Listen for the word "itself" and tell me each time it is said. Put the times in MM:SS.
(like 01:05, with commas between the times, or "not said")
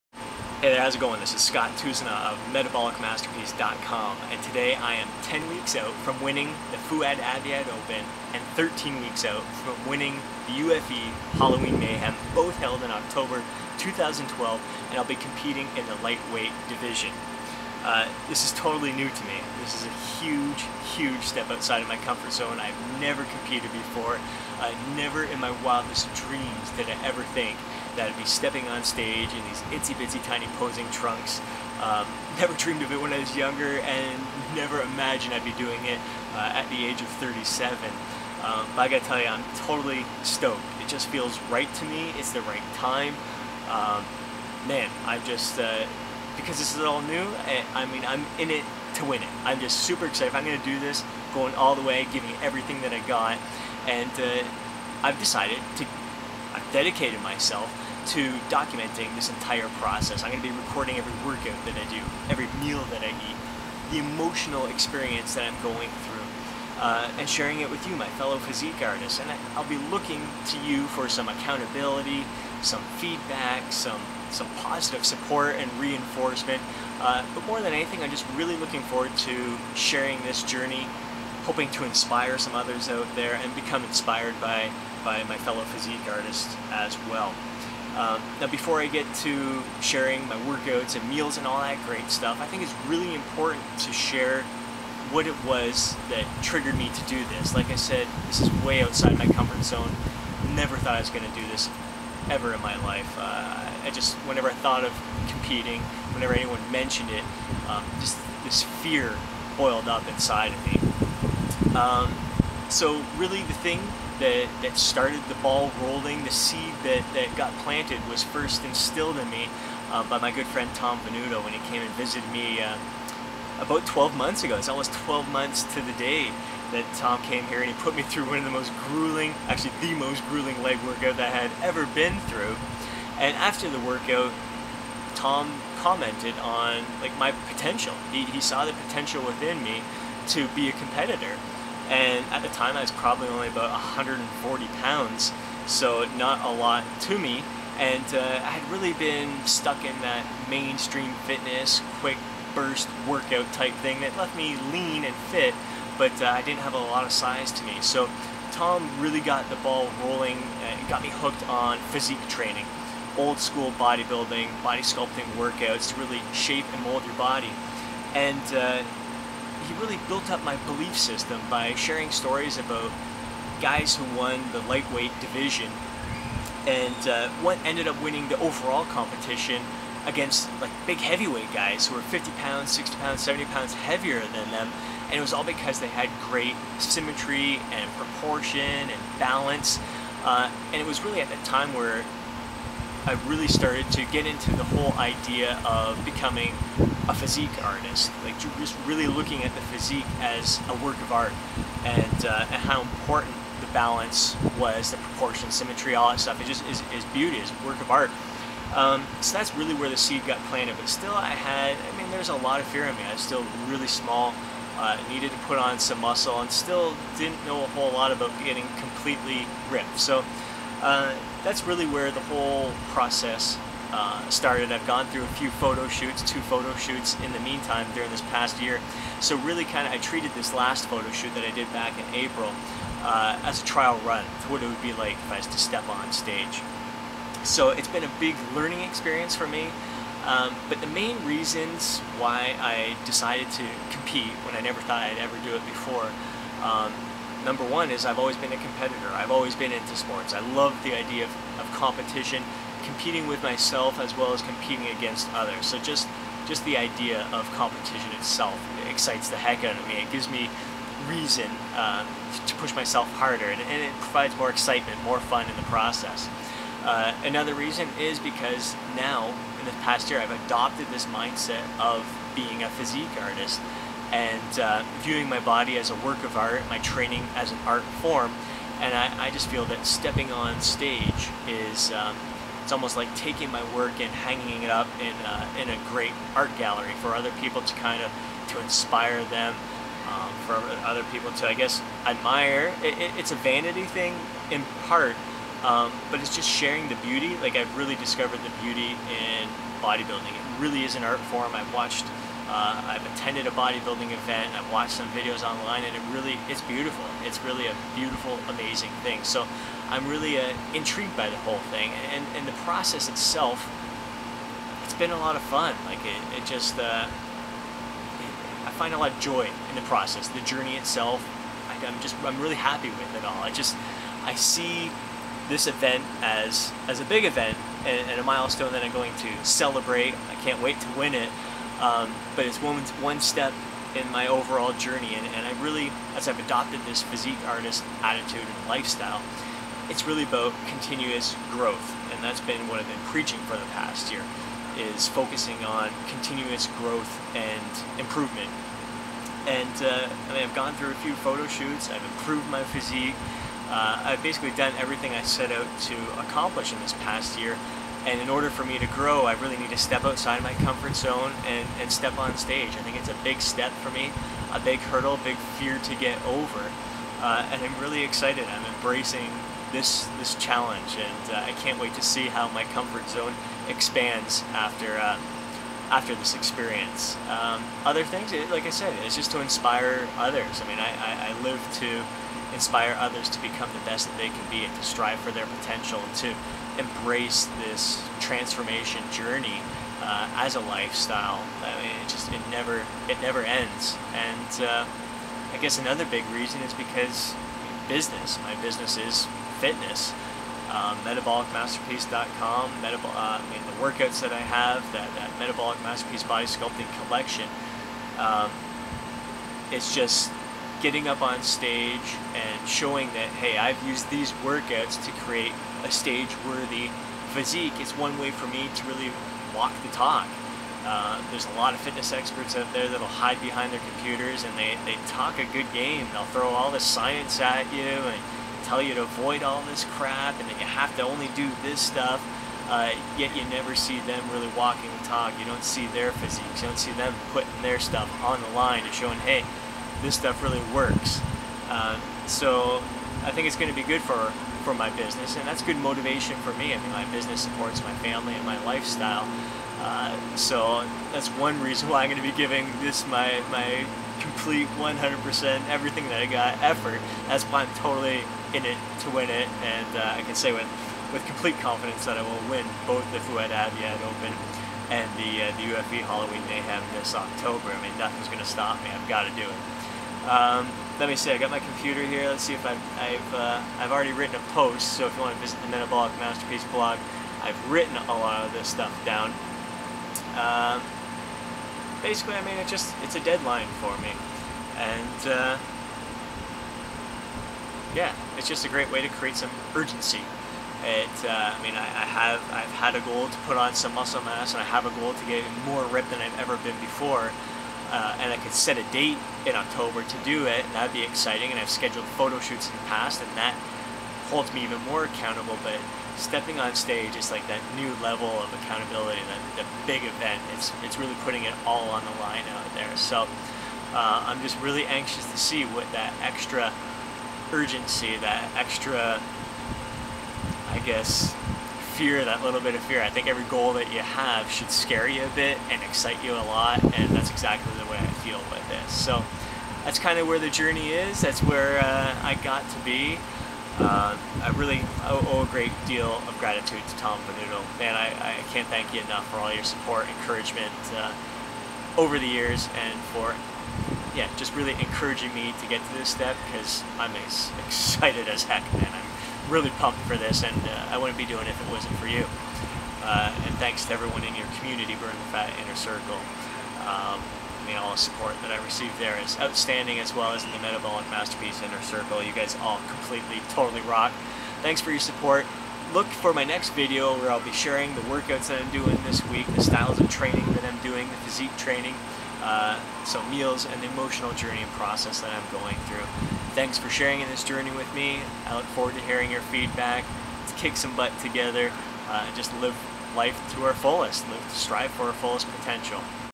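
04:18, 05:13, 05:20.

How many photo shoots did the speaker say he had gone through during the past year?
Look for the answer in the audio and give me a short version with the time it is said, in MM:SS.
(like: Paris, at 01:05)
two, at 03:46.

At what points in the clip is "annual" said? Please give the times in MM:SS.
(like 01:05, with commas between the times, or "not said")
not said.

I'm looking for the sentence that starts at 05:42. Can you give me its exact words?
And that's been what I've been preaching for the past year, is focusing on continuous growth and improvement.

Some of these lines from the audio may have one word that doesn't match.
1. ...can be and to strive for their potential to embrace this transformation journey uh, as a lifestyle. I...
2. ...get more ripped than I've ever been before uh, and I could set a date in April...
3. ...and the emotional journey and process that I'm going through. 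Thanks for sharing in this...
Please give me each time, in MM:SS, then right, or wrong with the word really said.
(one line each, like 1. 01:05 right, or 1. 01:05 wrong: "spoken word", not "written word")
1. 06:24 right
2. 08:15 wrong: "October", not "April"
3. 09:33 right.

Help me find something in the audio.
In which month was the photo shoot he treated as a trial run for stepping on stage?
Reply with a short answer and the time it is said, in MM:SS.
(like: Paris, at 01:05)
April, at 03:52.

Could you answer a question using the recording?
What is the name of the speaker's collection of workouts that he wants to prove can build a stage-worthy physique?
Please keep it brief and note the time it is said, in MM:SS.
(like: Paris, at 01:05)
Metabolic Masterpiece Body Sculpting Collection, at 06:45.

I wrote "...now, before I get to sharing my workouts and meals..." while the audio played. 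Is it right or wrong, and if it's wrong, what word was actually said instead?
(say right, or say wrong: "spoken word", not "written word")
right.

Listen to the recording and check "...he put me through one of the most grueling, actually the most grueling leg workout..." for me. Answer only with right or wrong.
right.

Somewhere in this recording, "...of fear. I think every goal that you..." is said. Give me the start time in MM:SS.
08:42.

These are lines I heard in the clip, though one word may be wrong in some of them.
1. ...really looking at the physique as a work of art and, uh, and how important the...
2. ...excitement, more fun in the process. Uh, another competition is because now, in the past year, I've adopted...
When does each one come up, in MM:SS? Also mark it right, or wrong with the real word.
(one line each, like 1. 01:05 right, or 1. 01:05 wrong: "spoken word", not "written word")
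1. 03:18 right
2. 04:24 wrong: "reason", not "competition".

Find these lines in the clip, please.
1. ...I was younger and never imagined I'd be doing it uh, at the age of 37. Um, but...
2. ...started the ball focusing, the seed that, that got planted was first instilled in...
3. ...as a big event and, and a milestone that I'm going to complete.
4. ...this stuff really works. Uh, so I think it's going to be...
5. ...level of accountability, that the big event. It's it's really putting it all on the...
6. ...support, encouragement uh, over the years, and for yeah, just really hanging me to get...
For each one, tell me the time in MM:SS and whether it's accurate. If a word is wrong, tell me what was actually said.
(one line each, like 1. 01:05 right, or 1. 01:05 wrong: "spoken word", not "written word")
1. 00:33 right
2. 01:54 wrong: "rolling", not "focusing"
3. 05:26 wrong: "celebrate", not "complete"
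4. 07:20 right
5. 08:28 right
6. 08:59 wrong: "encouraging", not "hanging".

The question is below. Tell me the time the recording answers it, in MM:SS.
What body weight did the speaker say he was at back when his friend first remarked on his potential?
02:23.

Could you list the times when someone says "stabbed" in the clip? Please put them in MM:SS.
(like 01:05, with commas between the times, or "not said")
not said.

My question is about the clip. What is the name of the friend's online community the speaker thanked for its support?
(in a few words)
Burn the Fat Inner Circle.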